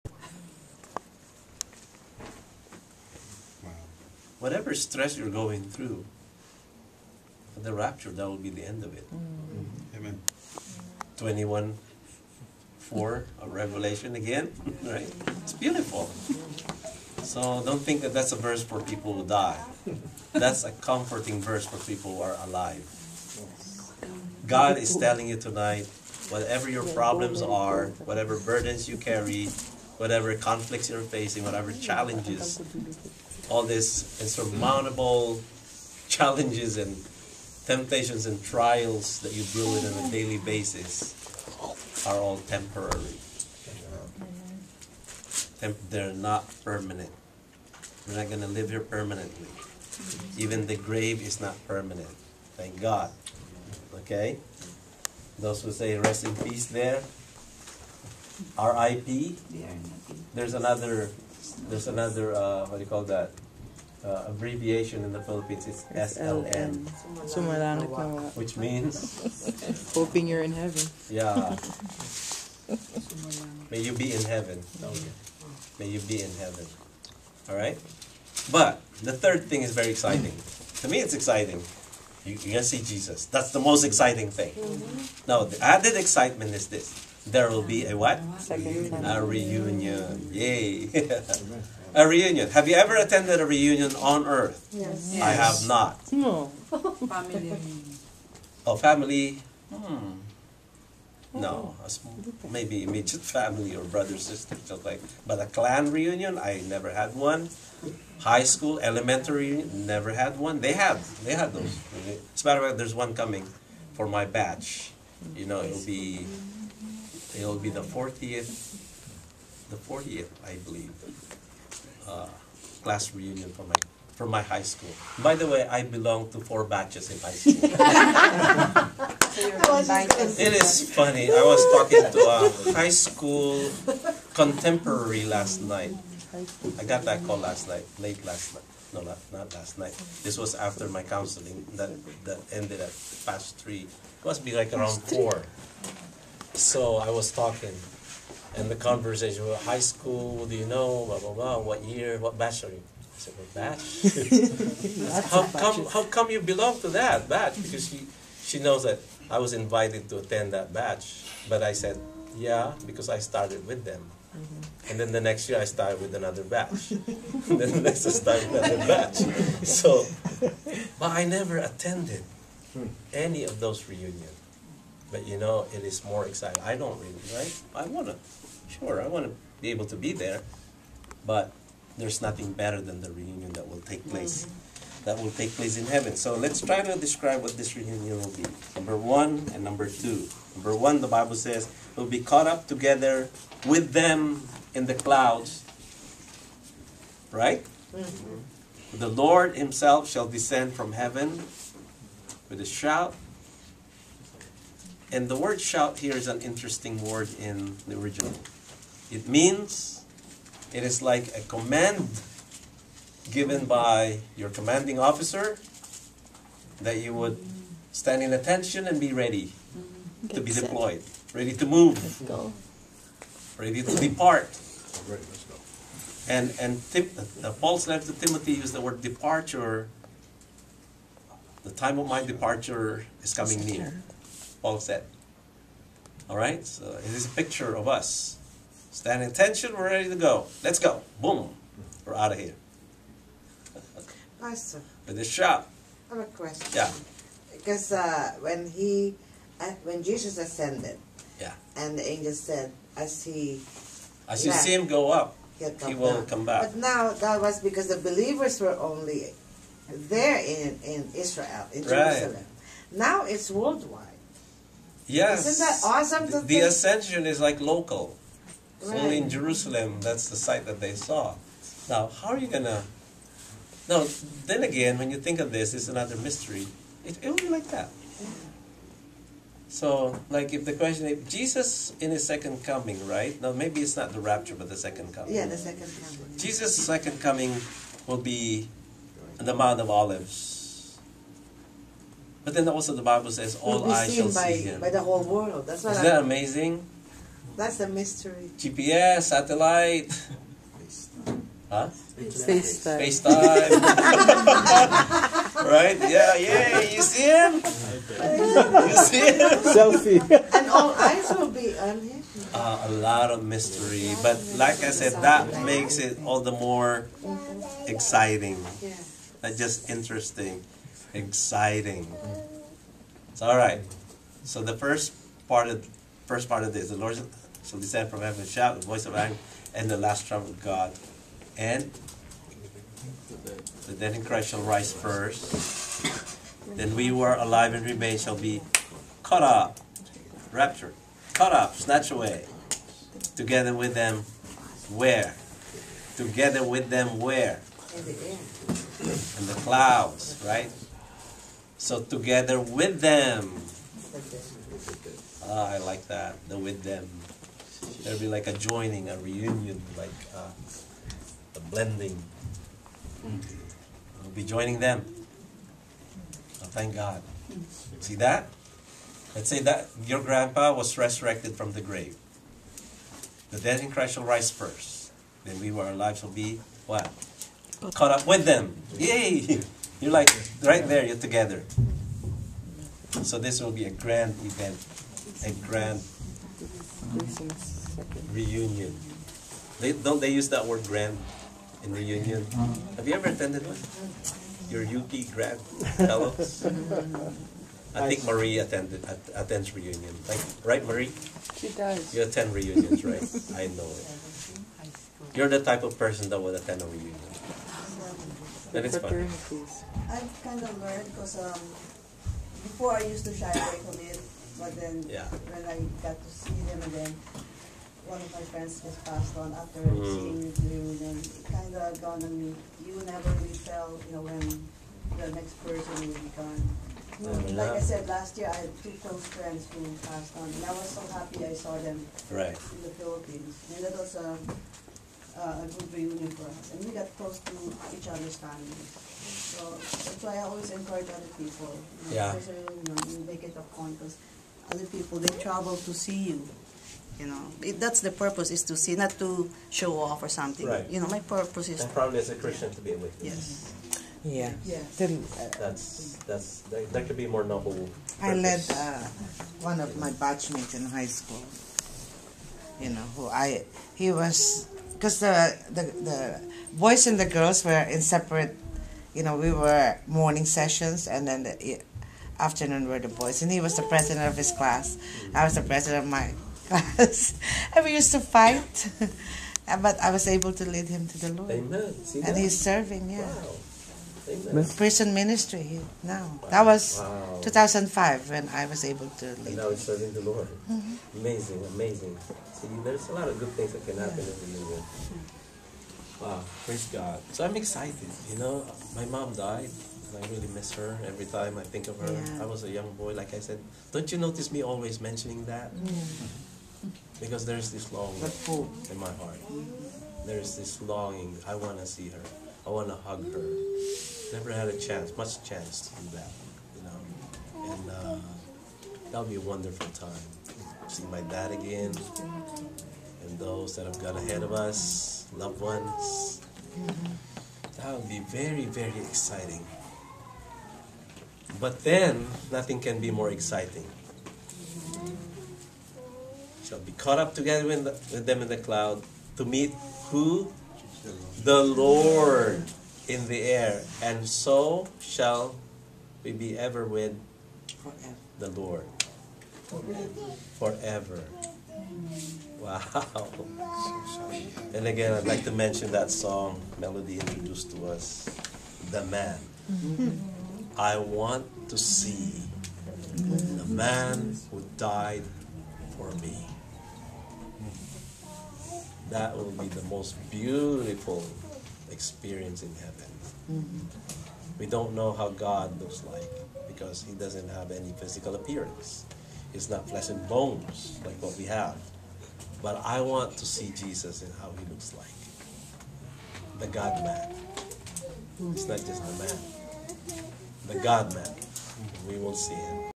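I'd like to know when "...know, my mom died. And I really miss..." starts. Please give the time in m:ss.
8:18.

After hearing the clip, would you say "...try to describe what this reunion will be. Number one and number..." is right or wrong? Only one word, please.
right.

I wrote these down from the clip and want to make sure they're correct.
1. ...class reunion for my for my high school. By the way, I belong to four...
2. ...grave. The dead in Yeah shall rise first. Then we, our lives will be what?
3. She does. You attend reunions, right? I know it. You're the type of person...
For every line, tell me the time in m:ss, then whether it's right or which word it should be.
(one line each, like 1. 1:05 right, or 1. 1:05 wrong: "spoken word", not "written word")
1. 2:02 right
2. 6:11 wrong: "Christ", not "Yeah"
3. 6:41 right.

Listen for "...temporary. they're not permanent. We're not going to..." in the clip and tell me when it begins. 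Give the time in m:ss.
0:42.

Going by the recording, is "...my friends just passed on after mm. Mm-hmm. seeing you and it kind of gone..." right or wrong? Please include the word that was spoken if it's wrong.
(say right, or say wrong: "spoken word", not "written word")
right.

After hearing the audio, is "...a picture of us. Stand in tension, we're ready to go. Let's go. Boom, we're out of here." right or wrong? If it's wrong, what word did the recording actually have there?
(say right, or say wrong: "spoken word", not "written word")
right.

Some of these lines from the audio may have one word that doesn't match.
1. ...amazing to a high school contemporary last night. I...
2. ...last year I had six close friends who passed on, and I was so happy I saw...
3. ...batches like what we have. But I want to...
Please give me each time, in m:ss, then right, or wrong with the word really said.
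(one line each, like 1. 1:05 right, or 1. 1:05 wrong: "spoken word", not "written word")
1. 2:11 wrong: "talking", not "amazing"
2. 7:08 wrong: "two", not "six"
3. 9:40 wrong: "bones", not "batches".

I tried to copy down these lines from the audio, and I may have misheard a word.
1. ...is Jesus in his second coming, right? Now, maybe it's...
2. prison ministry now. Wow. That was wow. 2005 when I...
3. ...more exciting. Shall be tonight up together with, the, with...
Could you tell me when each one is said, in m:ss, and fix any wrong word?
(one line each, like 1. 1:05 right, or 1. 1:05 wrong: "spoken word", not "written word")
1. 4:41 right
2. 8:04 right
3. 8:53 wrong: "caught", not "tonight".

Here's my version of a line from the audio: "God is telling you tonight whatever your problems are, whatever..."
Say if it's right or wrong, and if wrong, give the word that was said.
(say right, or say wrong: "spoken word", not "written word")
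right.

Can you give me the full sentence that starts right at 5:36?
Then we who are alive and remain shall be caught up, raptured, caught up, snatched away, together with them.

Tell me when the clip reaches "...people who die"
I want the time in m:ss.
0:18.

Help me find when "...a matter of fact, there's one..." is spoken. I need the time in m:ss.
1:52.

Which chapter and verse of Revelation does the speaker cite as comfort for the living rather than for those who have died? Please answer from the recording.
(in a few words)
21:4.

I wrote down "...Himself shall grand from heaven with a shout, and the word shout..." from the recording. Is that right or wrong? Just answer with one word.
wrong.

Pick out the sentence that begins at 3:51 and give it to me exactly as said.
The time of my departure is coming near.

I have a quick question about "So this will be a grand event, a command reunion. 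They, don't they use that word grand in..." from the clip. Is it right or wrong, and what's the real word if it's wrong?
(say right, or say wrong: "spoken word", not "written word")
wrong: "grand", not "command".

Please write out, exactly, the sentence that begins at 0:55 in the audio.
Those who say rest in peace there, RIP, there's another there's another uh, what do you call that?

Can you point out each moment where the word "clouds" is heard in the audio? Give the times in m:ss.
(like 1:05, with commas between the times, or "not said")
3:14, 5:49, 8:58.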